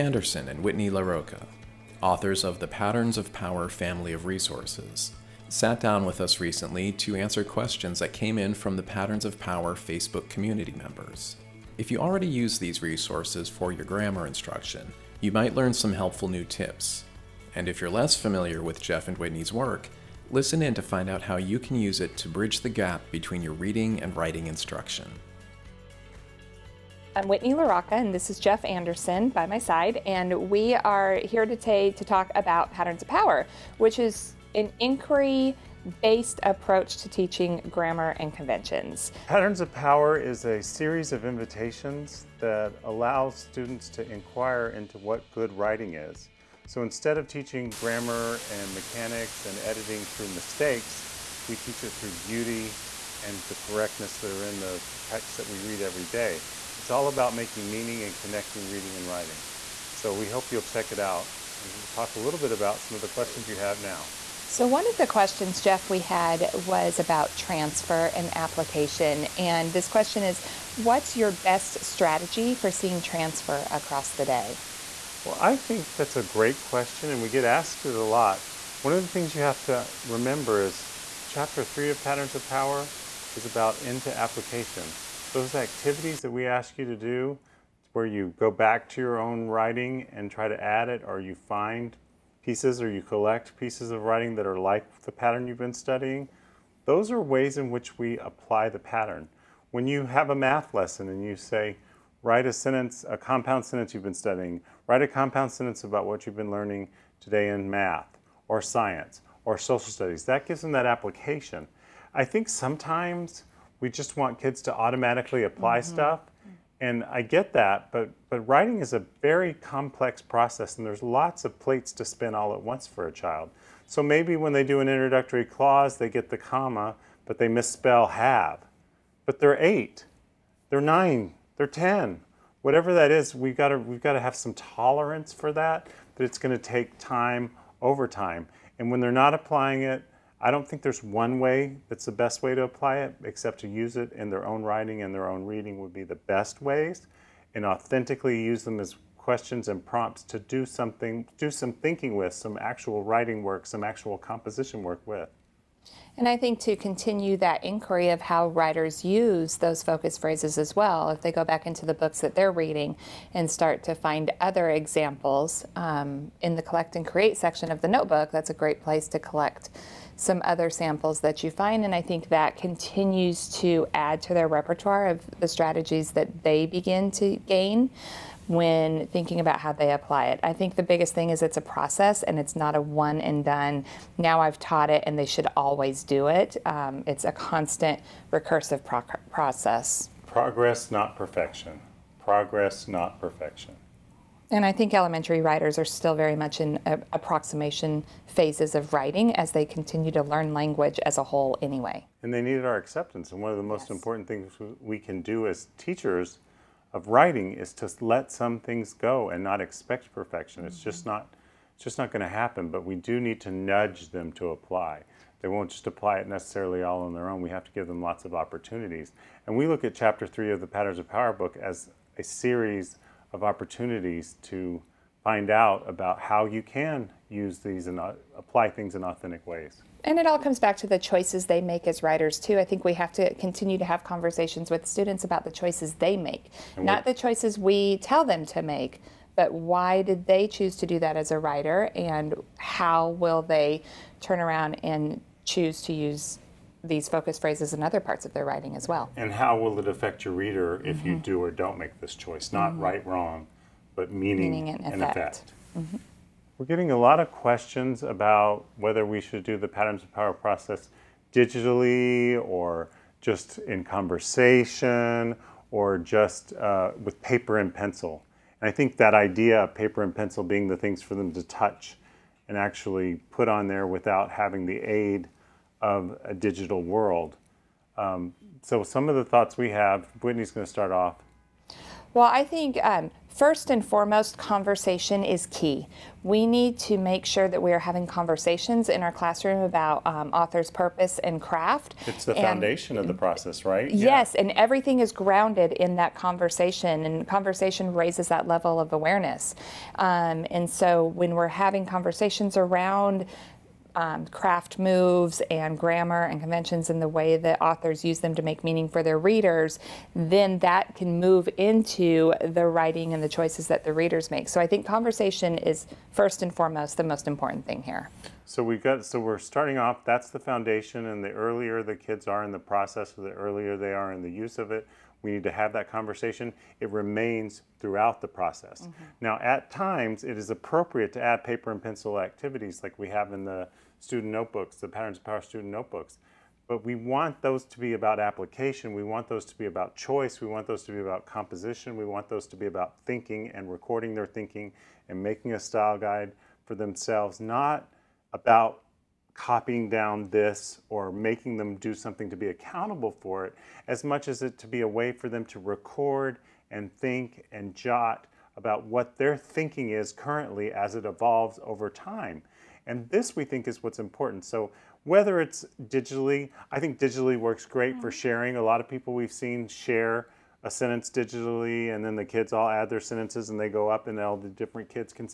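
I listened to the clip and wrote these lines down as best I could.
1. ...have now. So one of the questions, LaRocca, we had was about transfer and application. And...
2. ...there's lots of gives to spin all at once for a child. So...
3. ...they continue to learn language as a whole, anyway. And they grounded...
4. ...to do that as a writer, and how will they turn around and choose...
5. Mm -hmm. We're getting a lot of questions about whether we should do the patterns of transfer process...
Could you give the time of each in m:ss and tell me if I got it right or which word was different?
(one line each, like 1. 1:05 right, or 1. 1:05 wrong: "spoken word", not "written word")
1. 1:03 wrong: "Jeff", not "LaRocca"
2. 2:00 wrong: "plates", not "gives"
3. 3:19 wrong: "needed", not "grounded"
4. 4:00 right
5. 4:15 wrong: "power", not "transfer".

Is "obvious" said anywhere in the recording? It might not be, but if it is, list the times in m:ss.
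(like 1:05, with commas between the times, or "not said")
not said.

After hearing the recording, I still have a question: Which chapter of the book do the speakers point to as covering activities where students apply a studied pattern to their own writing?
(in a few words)
Chapter 3.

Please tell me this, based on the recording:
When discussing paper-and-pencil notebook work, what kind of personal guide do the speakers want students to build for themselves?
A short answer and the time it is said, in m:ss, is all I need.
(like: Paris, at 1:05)
style guide, at 5:45.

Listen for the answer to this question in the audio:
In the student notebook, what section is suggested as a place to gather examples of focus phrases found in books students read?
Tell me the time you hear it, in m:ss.
2:46.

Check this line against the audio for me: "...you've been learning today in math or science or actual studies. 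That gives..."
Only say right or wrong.
wrong.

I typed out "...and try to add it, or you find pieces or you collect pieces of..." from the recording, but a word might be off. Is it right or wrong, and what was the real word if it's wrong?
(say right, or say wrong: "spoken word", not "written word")
right.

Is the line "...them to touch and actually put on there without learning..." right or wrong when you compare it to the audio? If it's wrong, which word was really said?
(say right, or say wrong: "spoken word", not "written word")
wrong: "having", not "learning".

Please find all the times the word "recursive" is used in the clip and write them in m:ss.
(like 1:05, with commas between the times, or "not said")
3:08.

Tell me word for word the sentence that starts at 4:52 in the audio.
It's the and foundation of the process, right?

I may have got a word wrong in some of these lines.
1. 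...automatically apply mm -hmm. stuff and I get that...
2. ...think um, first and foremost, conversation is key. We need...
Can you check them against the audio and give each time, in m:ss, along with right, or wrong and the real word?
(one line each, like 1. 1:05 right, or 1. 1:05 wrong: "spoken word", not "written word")
1. 1:54 right
2. 4:42 right.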